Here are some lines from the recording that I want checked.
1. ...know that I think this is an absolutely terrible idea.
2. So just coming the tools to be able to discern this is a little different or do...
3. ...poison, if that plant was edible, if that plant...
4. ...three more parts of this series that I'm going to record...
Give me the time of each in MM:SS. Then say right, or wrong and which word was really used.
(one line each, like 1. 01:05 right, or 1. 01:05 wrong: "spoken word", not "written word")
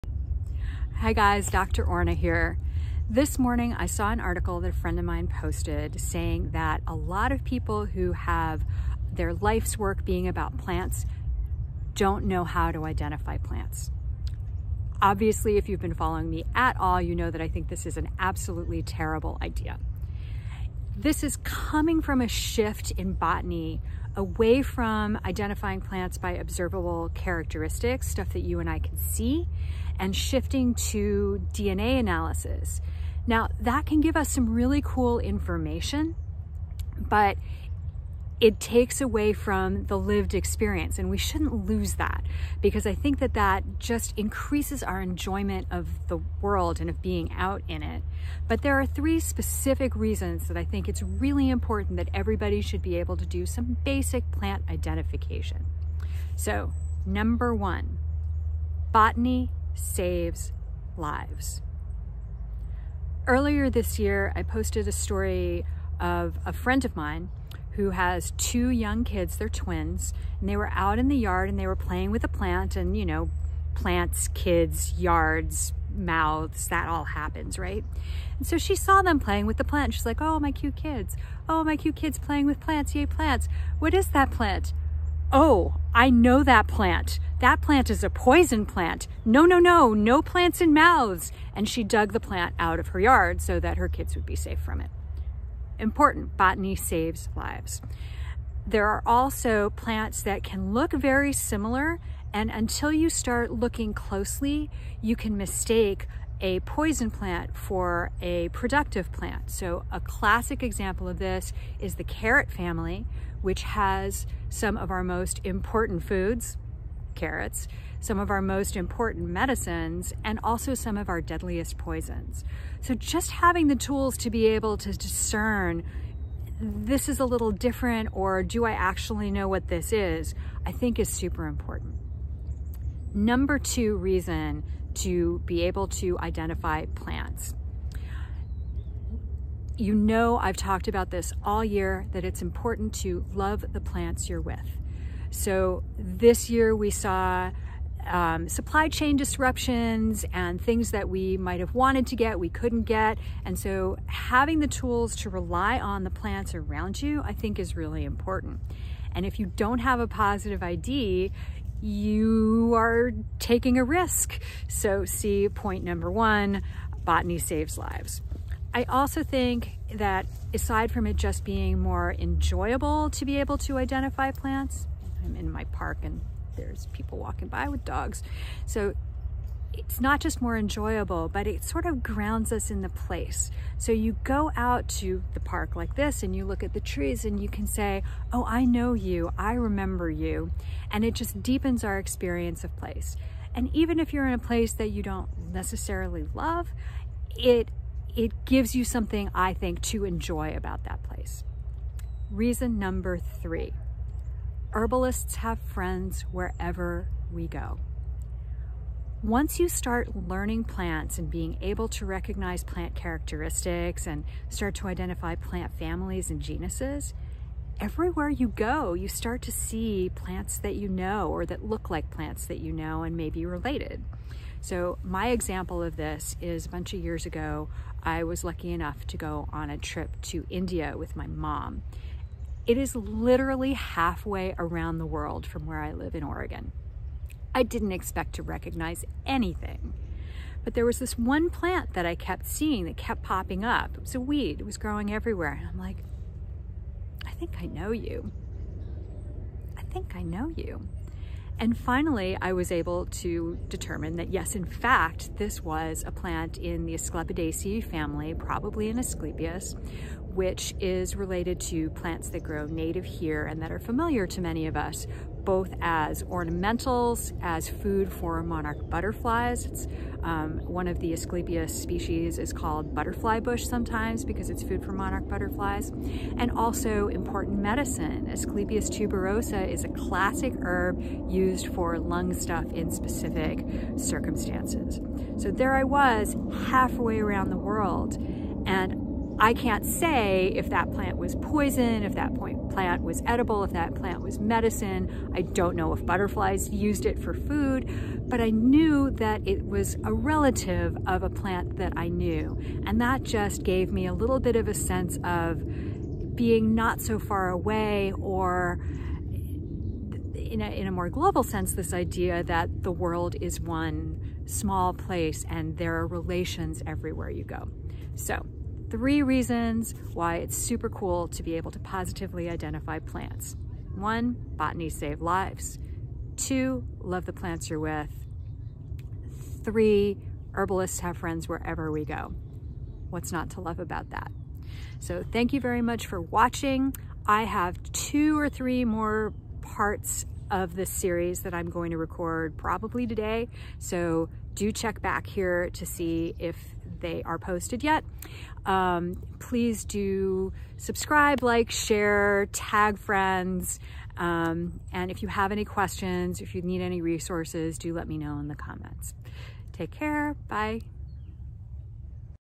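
1. 00:17 right
2. 02:02 wrong: "having", not "coming"
3. 04:51 right
4. 05:38 right.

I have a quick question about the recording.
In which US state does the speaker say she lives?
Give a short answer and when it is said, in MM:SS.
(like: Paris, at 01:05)
Oregon, at 03:56.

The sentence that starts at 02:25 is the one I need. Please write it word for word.
So this year we saw um, supply chain disruptions and things that we might have wanted to get, we couldn't get.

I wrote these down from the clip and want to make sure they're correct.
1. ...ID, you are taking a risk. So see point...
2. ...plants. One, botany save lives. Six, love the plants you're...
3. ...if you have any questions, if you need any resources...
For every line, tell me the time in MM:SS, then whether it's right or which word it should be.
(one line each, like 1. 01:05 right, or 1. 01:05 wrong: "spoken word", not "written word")
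1. 02:40 right
2. 05:22 wrong: "Two", not "Six"
3. 05:55 right.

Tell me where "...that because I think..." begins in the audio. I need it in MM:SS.
00:41.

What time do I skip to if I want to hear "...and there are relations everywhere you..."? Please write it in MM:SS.
05:15.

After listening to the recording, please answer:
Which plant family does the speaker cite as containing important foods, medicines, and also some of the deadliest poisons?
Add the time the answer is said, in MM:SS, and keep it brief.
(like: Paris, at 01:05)
carrot family, at 01:52.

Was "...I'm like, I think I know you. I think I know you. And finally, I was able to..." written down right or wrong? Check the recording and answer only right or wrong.
right.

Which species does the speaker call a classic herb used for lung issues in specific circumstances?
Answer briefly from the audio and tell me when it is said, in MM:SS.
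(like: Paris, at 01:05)
Asclepias tuberosa, at 04:38.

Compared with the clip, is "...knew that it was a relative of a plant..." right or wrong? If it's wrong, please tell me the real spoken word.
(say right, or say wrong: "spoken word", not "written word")
right.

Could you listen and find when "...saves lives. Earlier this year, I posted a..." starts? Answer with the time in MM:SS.
00:59.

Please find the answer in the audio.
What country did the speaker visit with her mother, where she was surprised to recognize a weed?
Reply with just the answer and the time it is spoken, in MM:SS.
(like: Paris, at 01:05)
India, at 03:50.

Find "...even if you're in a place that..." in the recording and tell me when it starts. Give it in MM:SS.
03:13.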